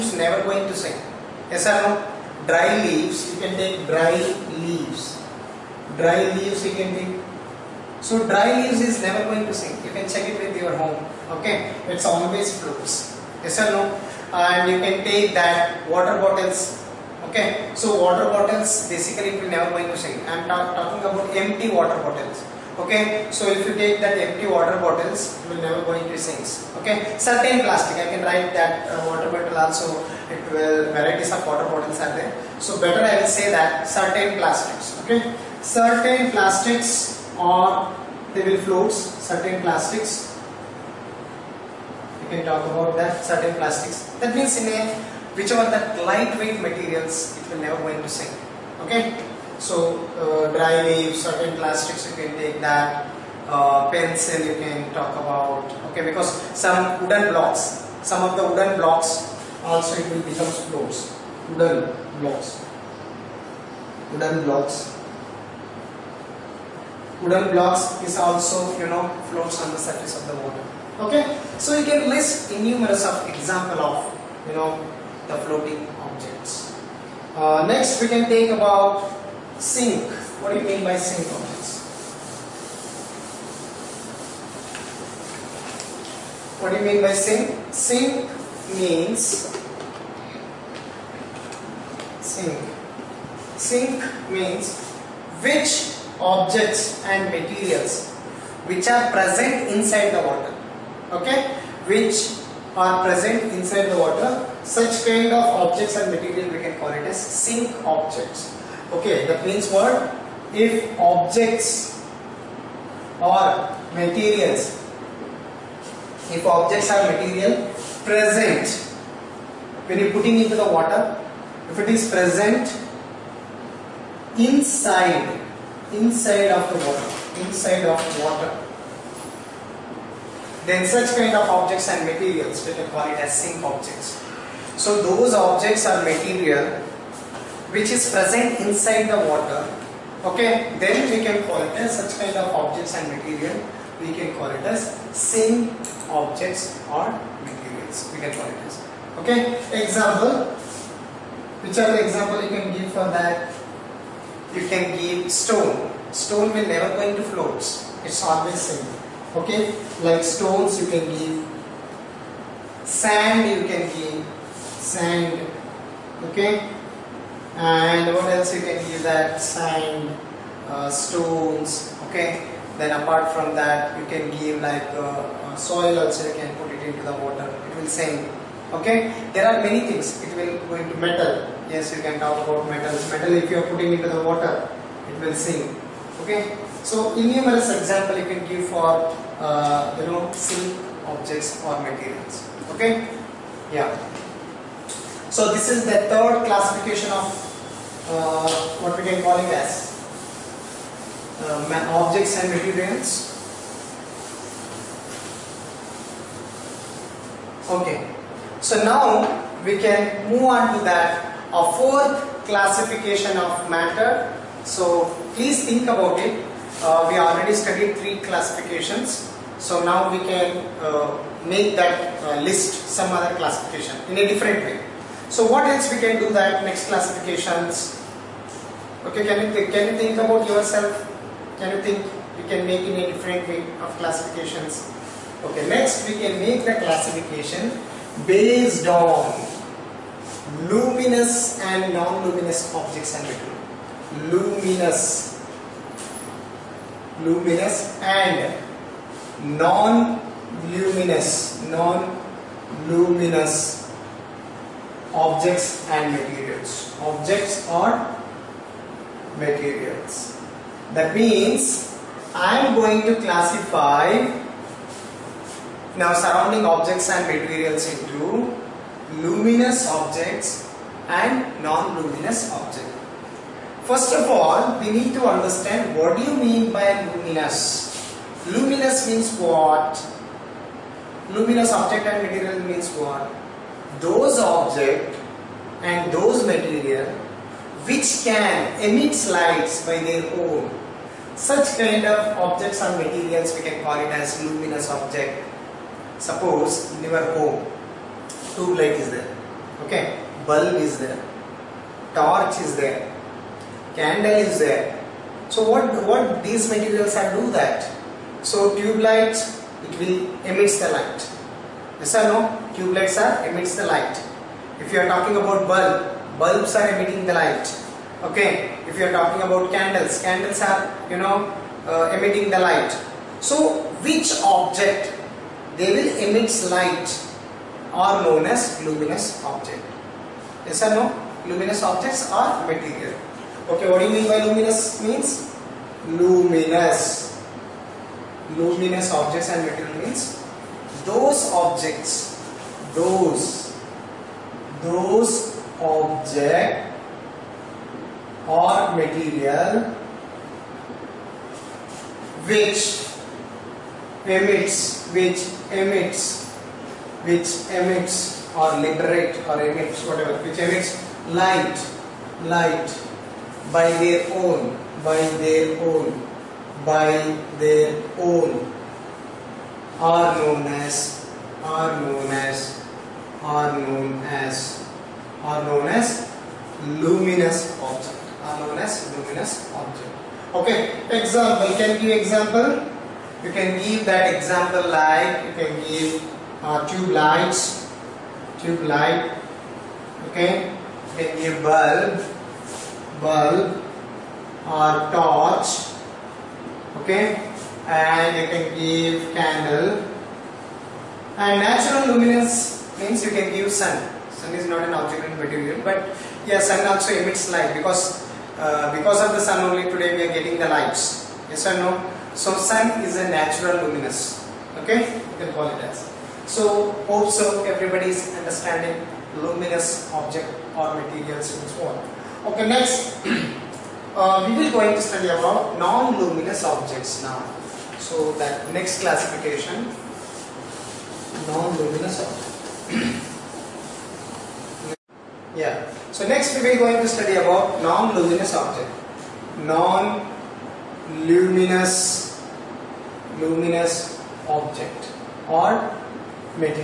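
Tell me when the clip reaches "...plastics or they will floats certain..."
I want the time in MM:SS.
00:36.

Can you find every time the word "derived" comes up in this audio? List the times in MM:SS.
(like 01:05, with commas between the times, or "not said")
not said.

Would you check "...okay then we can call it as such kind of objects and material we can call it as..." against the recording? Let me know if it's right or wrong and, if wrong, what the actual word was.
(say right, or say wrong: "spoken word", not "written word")
right.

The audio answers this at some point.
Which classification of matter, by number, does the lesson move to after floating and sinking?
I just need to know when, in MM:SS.
03:31.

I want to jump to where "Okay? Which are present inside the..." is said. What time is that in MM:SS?
01:41.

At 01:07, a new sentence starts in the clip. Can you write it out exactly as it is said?
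Wooden blocks is also, you know, floats on the surface of the water.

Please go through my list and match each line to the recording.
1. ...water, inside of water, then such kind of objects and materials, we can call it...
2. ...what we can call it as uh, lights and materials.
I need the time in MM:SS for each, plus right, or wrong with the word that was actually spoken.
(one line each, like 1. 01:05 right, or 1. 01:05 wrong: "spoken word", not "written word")
1. 02:06 right
2. 03:18 wrong: "objects", not "lights".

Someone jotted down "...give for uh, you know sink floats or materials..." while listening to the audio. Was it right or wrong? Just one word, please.
wrong.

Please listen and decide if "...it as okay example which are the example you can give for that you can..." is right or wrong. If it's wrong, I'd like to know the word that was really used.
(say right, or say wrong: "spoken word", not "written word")
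right.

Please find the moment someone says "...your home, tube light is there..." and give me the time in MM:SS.
04:57.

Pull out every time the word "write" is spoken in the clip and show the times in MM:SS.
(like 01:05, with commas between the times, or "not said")
00:28.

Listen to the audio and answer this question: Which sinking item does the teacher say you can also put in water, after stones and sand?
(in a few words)
soil.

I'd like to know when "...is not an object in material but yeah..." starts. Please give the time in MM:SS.
06:44.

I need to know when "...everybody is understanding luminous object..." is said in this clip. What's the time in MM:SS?
06:57.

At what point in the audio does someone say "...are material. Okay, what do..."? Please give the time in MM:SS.
05:32.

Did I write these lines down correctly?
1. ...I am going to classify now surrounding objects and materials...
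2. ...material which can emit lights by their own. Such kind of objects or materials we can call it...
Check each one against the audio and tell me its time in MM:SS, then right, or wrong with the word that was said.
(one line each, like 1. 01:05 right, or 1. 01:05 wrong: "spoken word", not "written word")
1. 04:22 right
2. 04:46 right.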